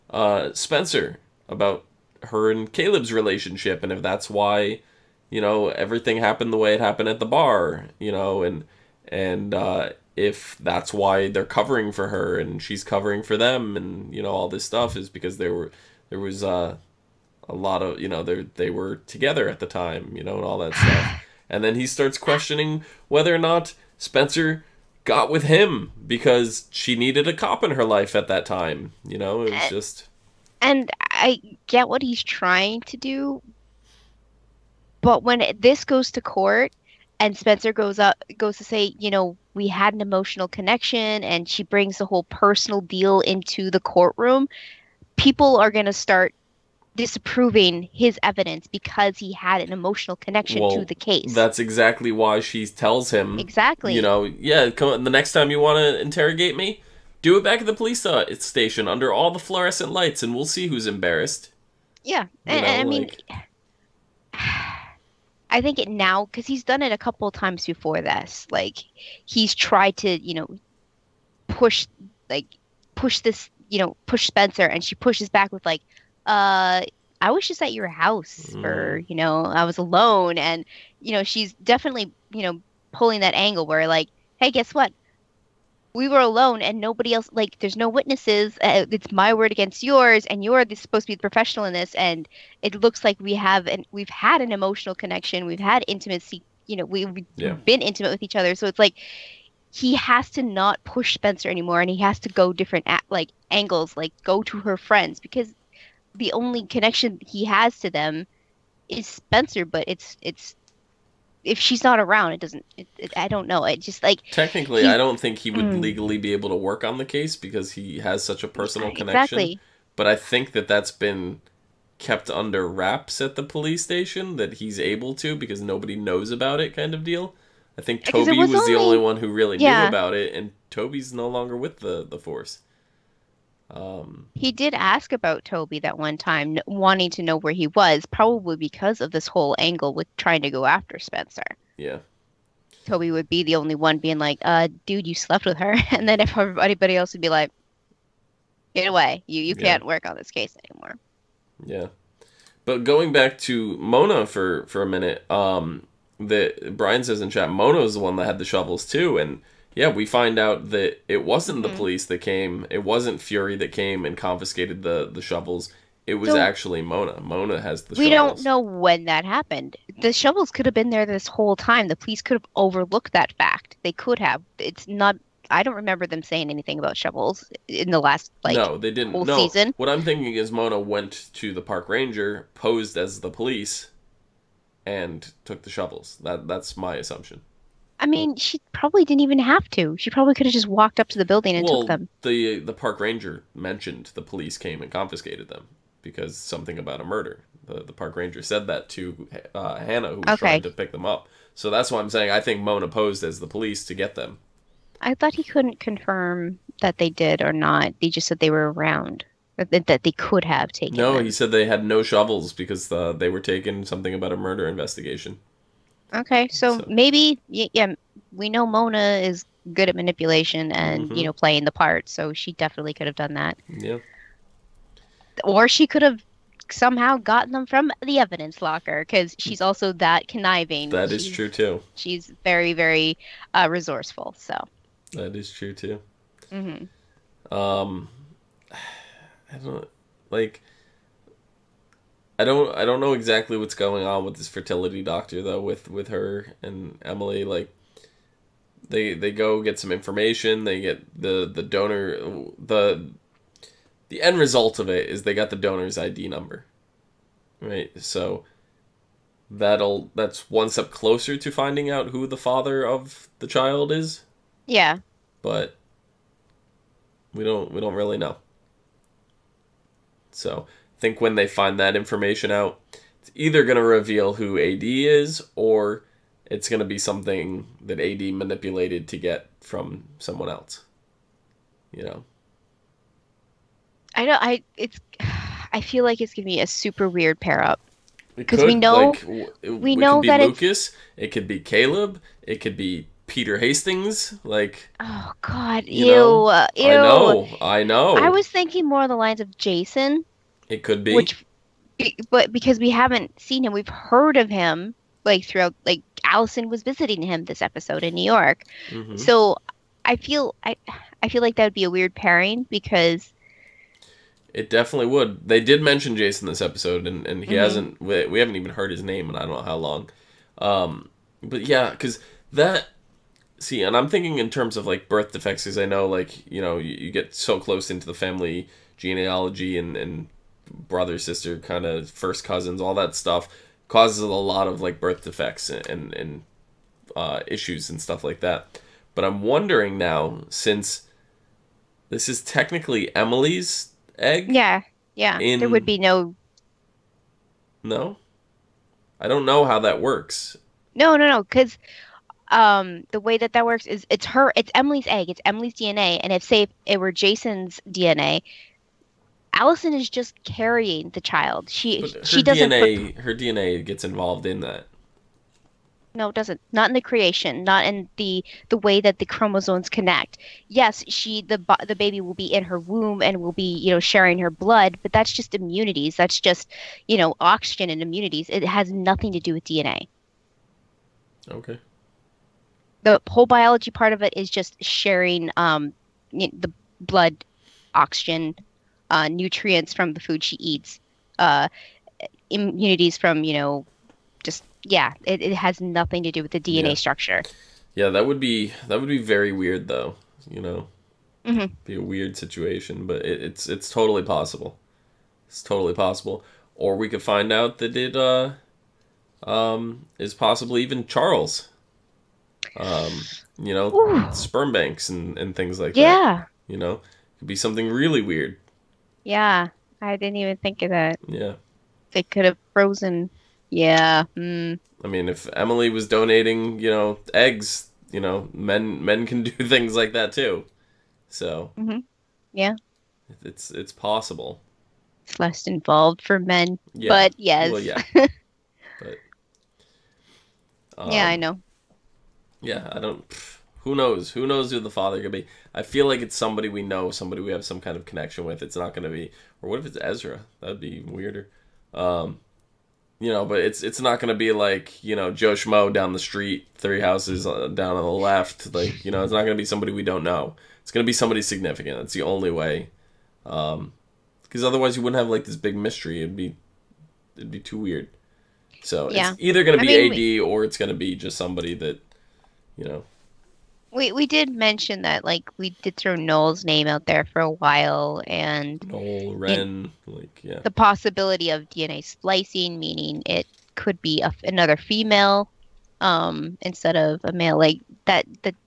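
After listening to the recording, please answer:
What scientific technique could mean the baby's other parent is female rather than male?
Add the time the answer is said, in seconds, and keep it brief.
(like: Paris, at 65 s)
DNA splicing, at 481 s.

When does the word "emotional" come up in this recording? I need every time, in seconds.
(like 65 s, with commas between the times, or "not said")
40 s, 49 s, 94 s.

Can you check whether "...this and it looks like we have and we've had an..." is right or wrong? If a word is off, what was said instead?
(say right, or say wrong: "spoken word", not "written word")
right.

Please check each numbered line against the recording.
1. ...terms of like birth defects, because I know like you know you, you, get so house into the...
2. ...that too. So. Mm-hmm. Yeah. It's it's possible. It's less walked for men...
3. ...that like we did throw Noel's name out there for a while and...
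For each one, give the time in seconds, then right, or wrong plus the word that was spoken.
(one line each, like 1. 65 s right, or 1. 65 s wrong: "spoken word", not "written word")
1. 324 s wrong: "close", not "house"
2. 430 s wrong: "involved", not "walked"
3. 475 s right.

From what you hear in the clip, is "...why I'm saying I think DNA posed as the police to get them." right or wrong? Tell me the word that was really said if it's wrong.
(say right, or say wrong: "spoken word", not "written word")
wrong: "Mona", not "DNA".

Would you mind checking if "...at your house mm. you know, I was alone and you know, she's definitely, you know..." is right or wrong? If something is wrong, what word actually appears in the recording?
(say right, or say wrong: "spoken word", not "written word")
right.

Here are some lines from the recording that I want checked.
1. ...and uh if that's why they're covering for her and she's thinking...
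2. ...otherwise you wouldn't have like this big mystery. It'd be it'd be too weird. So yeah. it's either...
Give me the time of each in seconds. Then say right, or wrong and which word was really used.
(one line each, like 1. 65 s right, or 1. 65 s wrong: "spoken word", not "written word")
1. 9 s wrong: "covering", not "thinking"
2. 464 s right.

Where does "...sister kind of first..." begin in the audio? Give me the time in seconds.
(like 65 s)
331 s.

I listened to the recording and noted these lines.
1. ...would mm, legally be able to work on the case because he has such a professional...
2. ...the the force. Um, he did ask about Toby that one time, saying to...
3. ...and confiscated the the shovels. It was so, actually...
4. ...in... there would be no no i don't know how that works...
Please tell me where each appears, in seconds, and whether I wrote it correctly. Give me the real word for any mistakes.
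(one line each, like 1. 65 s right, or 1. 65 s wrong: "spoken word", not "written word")
1. 115 s wrong: "personal", not "professional"
2. 131 s wrong: "wanting", not "saying"
3. 164 s right
4. 345 s right.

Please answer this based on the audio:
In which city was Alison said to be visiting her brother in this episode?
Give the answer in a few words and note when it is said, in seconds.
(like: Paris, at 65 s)
New York, at 308 s.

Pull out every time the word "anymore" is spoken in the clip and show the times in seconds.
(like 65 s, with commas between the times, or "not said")
101 s, 150 s.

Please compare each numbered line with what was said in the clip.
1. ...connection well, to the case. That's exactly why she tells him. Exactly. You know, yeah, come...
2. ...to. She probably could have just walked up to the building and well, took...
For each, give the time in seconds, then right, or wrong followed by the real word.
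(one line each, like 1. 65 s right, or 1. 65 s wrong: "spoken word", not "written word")
1. 50 s right
2. 189 s right.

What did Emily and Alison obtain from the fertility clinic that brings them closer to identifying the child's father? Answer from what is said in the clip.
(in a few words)
The donor's ID number.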